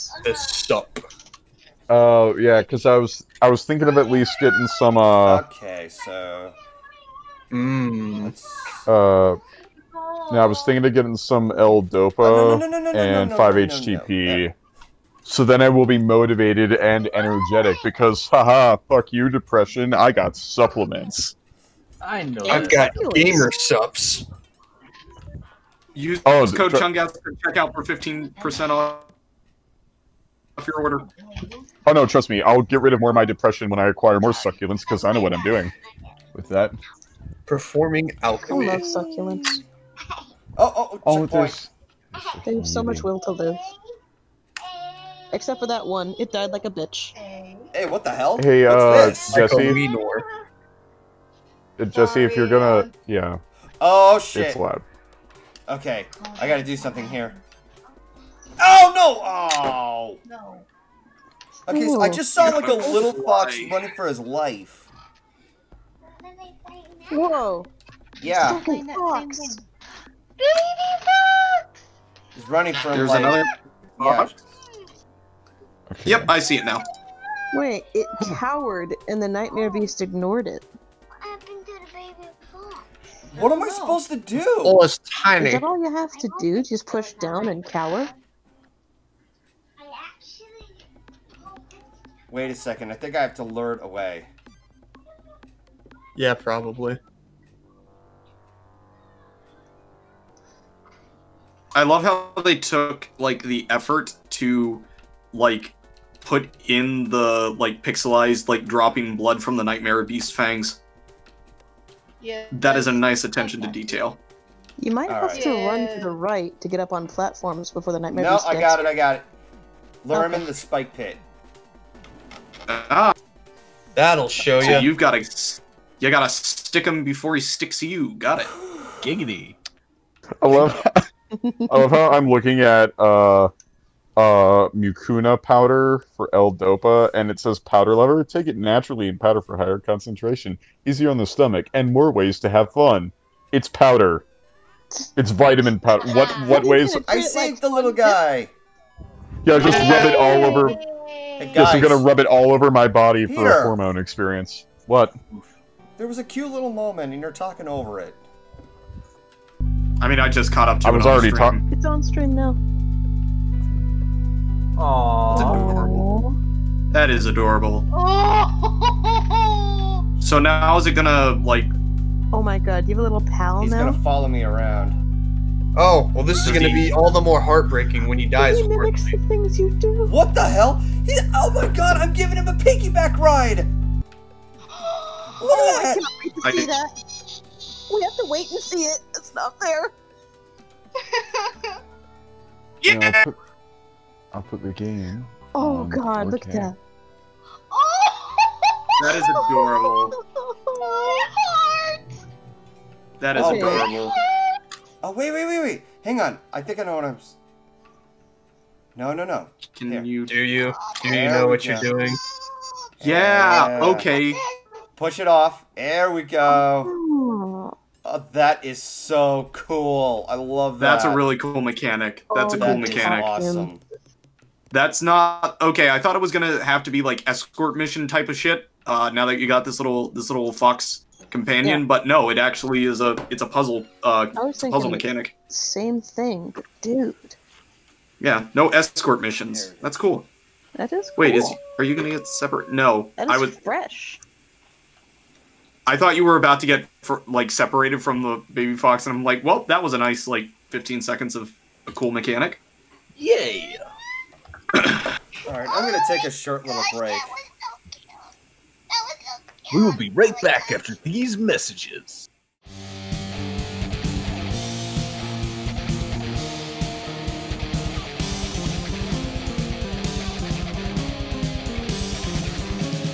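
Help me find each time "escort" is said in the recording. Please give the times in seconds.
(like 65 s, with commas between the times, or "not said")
227 s, 238 s.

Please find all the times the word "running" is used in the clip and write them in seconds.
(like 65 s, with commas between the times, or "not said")
63 s, 72 s.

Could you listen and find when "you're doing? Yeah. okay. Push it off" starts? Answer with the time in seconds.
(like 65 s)
211 s.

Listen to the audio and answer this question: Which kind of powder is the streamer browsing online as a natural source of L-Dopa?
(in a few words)
mucuna powder.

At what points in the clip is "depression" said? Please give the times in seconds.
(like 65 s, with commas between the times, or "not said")
19 s, 33 s.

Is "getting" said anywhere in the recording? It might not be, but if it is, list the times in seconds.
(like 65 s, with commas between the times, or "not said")
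4 s, 10 s.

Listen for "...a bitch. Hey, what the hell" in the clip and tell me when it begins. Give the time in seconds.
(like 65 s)
46 s.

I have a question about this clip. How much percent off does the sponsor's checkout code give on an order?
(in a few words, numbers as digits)
15%.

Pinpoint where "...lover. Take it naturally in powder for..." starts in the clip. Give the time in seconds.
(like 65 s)
137 s.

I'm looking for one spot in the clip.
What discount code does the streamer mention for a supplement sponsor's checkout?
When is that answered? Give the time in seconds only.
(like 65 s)
26 s.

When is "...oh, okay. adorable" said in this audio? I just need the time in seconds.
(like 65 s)
203 s.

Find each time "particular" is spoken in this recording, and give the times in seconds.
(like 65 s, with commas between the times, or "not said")
not said.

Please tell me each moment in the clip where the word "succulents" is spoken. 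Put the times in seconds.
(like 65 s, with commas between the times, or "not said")
34 s, 38 s.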